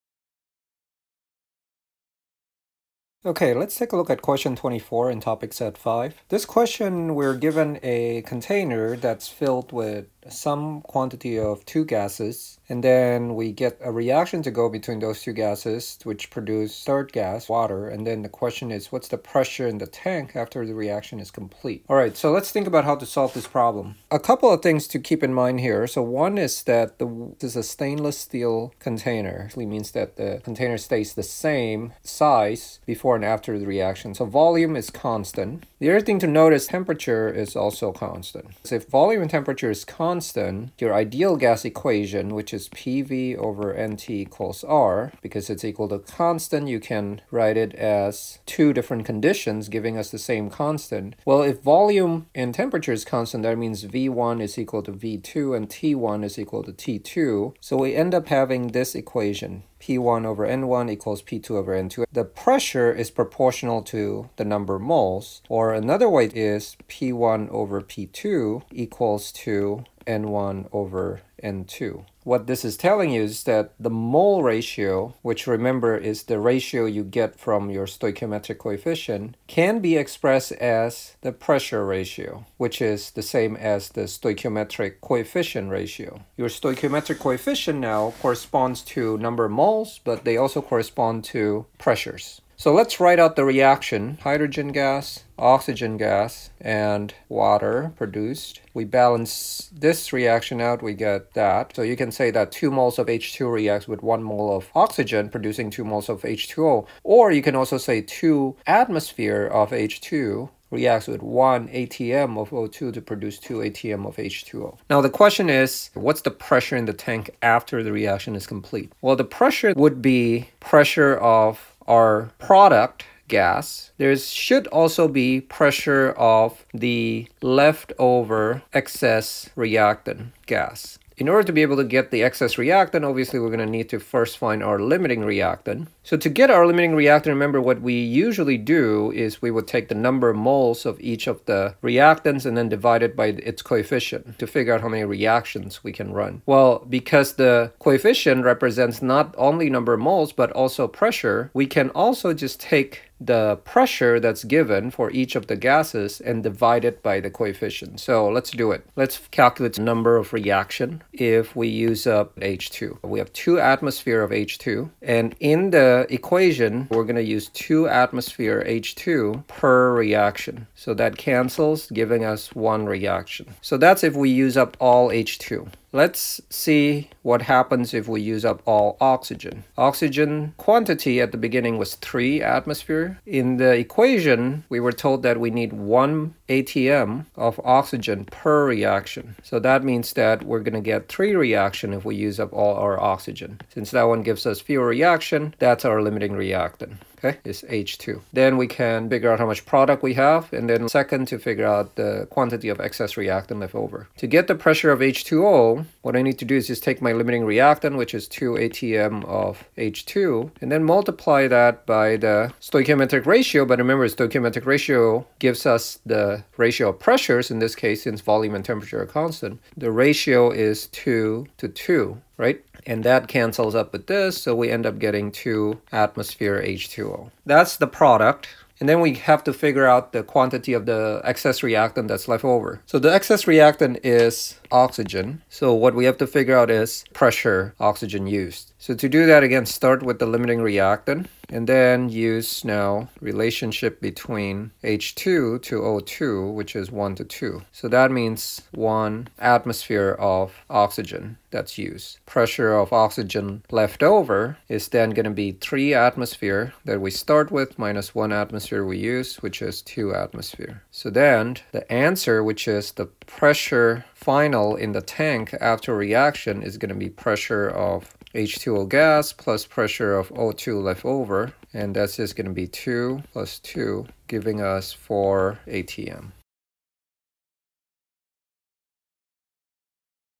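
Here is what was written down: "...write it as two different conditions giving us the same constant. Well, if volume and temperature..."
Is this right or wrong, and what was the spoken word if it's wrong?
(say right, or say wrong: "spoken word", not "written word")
right.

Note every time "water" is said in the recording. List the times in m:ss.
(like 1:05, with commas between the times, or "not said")
0:17, 1:37.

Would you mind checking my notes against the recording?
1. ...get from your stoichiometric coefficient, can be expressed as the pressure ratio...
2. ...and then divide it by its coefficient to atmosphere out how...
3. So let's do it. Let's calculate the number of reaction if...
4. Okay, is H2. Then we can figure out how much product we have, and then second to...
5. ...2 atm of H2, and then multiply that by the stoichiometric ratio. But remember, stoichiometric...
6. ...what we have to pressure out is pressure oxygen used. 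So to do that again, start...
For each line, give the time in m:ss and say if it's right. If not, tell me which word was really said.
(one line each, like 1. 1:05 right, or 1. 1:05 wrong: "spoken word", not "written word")
1. 1:17 right
2. 2:22 wrong: "figure", not "atmosphere"
3. 2:37 right
4. 3:17 right
5. 3:28 right
6. 3:55 wrong: "figure", not "pressure".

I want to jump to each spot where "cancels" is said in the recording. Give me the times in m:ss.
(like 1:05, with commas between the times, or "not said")
2:51, 3:43.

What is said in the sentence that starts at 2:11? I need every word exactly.
In order to be able to get the excess reactant, obviously we're going to need to first find our limiting reactant.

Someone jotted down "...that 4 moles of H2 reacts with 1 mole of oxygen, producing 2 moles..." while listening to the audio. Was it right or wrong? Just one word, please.
wrong.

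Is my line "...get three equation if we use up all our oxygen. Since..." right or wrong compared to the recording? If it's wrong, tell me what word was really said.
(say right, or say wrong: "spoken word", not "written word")
wrong: "reaction", not "equation".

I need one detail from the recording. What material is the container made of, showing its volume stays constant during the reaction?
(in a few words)
Stainless steel.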